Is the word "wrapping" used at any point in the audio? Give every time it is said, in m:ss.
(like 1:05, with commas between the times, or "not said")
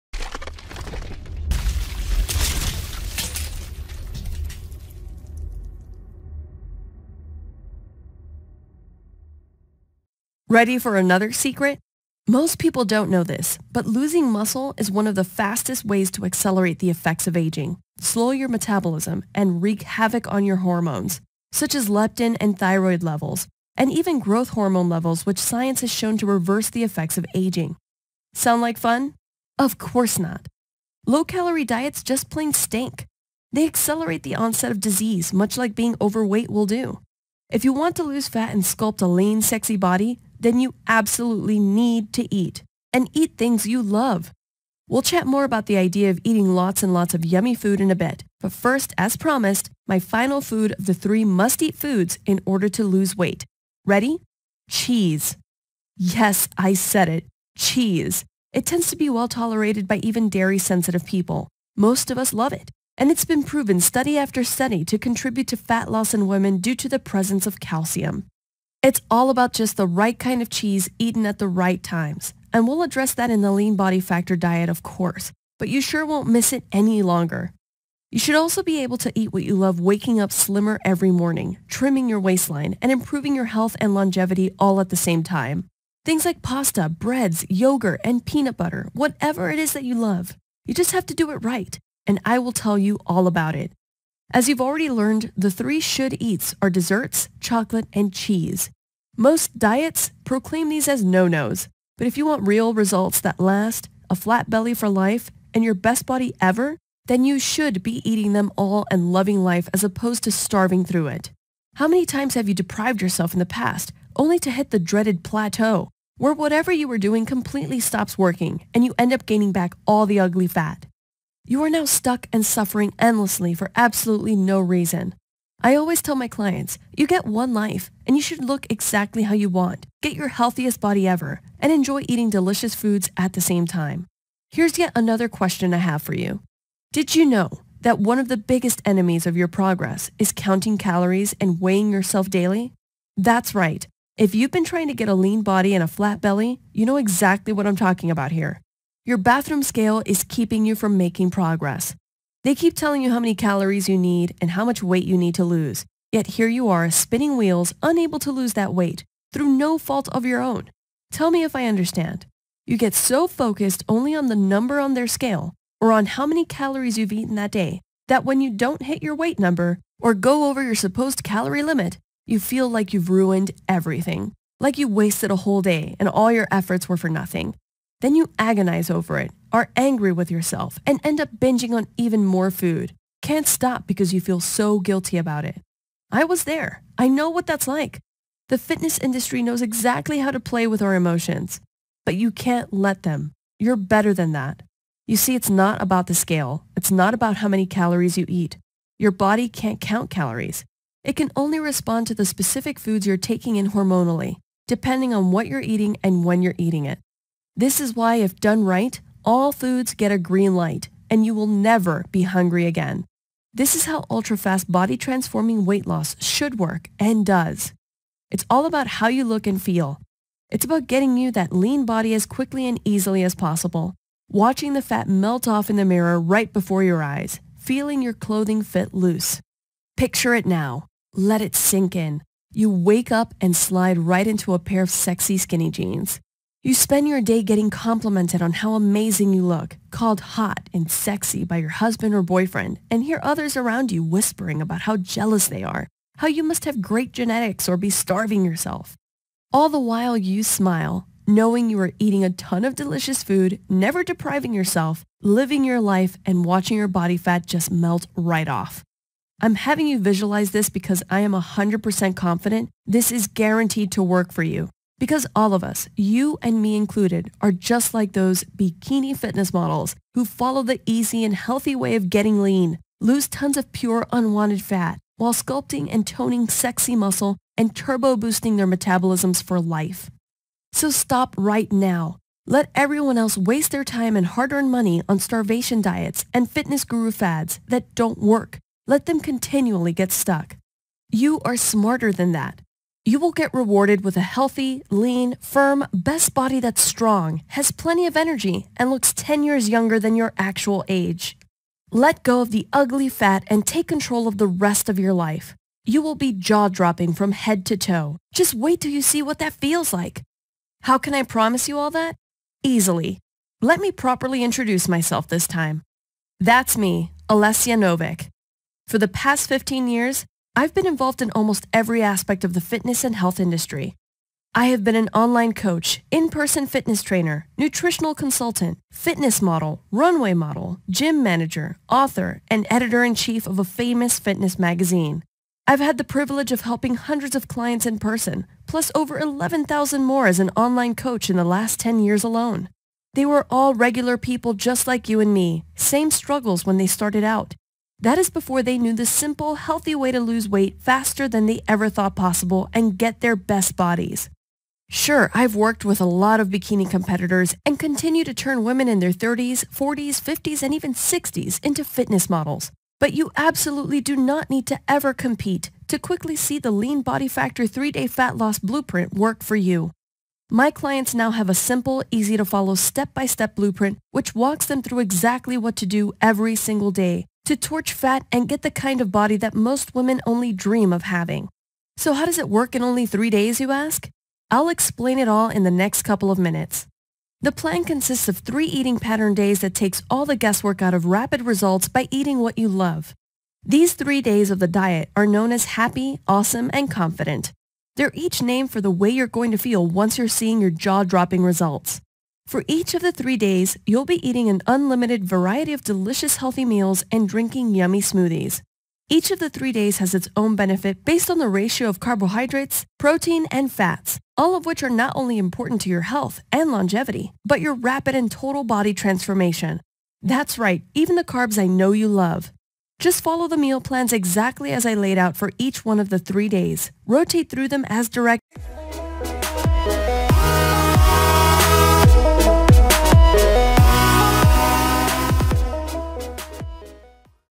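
not said.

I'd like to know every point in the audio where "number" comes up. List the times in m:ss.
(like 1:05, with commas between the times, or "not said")
2:44, 2:49.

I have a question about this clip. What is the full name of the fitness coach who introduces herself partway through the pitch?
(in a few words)
Alessia Novik.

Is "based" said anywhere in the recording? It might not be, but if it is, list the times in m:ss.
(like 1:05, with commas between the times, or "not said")
6:51.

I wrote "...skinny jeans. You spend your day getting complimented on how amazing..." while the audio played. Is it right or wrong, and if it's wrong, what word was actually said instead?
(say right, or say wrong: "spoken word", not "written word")
right.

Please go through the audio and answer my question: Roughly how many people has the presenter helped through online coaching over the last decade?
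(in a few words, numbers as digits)
11,000.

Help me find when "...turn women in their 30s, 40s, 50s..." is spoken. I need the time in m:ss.
5:58.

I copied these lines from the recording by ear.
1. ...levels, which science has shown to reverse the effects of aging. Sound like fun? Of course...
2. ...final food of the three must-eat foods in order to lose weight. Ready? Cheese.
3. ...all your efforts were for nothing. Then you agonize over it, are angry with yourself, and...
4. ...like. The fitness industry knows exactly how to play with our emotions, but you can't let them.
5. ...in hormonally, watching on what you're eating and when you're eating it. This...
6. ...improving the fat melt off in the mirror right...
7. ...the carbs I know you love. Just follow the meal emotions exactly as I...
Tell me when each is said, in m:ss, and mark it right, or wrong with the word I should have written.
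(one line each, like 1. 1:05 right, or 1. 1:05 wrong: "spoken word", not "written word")
1. 0:24 right
2. 0:49 right
3. 2:56 right
4. 3:07 right
5. 3:23 wrong: "depending", not "watching"
6. 3:44 wrong: "watching", not "improving"
7. 7:01 wrong: "plans", not "emotions".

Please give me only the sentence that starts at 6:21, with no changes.
So how does it work in only three days, you ask?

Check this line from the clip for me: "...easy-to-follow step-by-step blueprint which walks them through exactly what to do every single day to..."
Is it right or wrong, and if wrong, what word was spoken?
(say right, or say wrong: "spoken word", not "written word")
right.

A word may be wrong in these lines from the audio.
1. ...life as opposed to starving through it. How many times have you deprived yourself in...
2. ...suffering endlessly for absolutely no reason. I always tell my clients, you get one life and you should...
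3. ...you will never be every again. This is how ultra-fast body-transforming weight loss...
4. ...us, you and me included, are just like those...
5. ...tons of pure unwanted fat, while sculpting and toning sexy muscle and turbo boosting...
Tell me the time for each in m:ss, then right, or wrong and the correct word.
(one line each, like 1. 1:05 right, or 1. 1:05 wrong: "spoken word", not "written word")
1. 1:49 right
2. 2:02 right
3. 3:31 wrong: "hungry", not "every"
4. 4:25 right
5. 4:33 right.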